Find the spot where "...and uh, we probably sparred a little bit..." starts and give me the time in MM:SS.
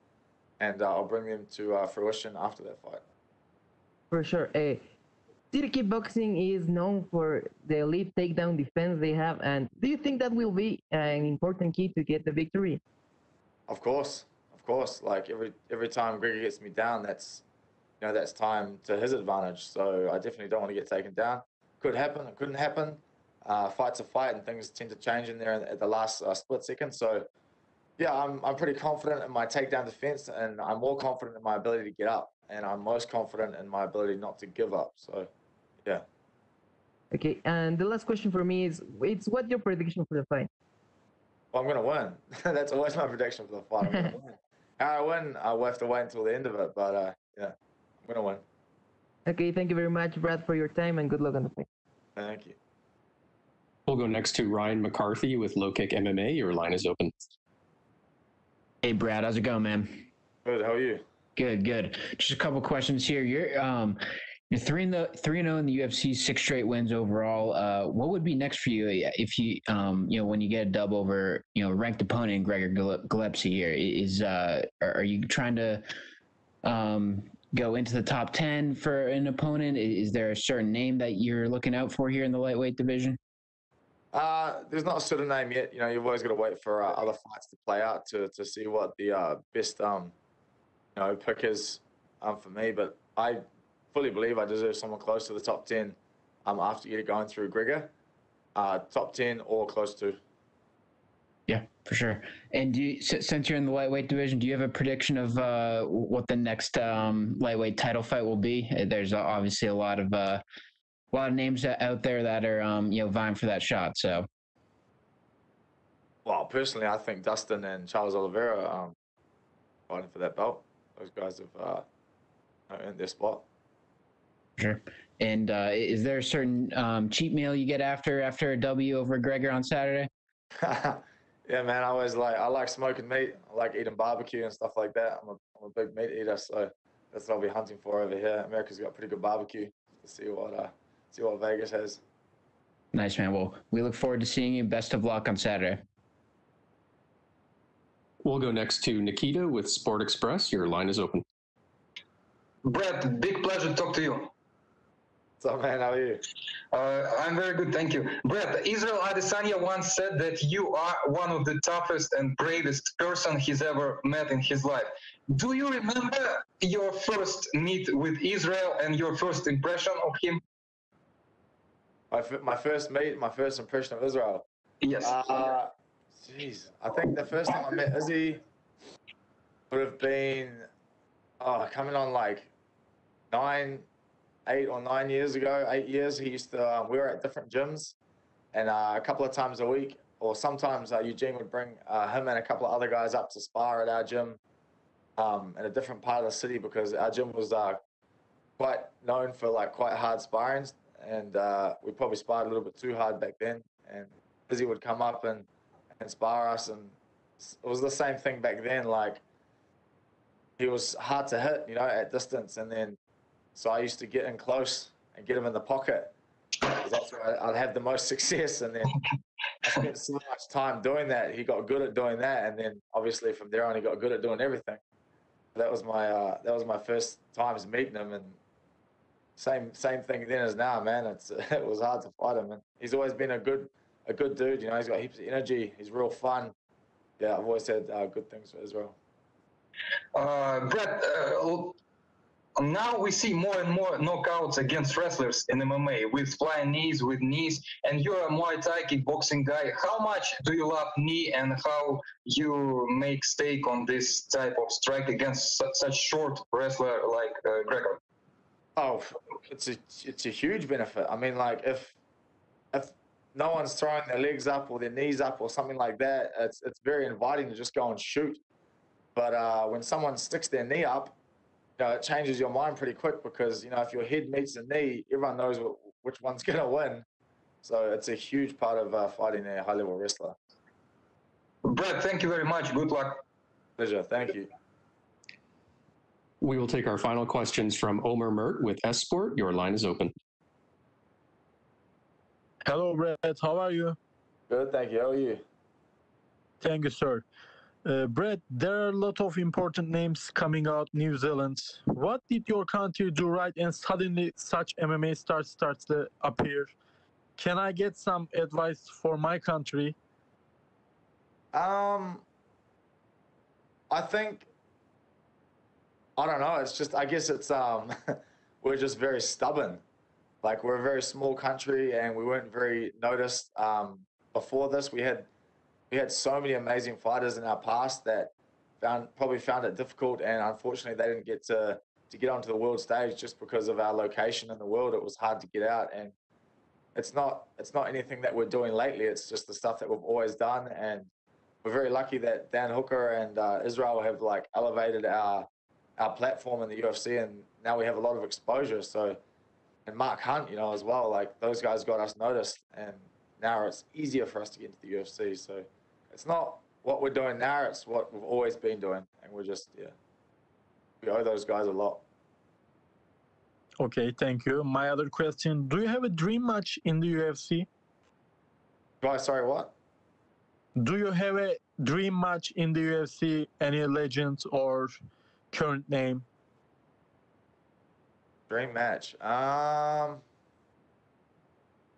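03:21.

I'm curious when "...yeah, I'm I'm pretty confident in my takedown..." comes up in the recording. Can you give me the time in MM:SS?
00:27.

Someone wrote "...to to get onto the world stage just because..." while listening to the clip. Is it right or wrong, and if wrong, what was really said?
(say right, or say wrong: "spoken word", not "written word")
right.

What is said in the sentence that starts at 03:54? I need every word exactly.
You know, he's got heaps of energy.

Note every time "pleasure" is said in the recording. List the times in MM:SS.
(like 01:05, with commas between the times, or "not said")
02:33, 04:43.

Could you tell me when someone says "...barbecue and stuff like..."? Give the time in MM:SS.
02:13.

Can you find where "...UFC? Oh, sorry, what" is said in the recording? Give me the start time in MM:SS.
06:07.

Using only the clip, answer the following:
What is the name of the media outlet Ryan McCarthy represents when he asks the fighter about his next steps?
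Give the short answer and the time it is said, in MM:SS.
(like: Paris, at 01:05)
Low Kick MMA, at 00:55.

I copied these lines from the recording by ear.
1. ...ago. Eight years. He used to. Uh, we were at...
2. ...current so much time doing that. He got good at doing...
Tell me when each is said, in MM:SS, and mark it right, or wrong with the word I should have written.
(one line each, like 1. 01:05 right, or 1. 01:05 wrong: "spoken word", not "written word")
1. 03:05 right
2. 03:39 wrong: "spent", not "current".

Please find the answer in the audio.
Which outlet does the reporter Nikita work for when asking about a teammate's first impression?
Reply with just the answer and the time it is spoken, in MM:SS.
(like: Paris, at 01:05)
Sport Express, at 02:29.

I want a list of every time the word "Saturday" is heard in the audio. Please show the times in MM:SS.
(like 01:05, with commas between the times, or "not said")
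02:09, 02:25.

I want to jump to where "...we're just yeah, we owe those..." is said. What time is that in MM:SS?
05:59.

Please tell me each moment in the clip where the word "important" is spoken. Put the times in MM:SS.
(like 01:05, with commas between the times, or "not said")
00:11, 04:59.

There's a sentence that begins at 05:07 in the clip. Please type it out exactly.
Can I get some advice for my country?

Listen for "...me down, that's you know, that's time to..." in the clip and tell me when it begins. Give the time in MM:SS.
00:16.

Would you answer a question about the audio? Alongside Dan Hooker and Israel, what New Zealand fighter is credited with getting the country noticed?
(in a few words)
Mark Hunt.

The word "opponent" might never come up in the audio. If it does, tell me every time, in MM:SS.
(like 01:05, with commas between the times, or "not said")
01:12, 01:19.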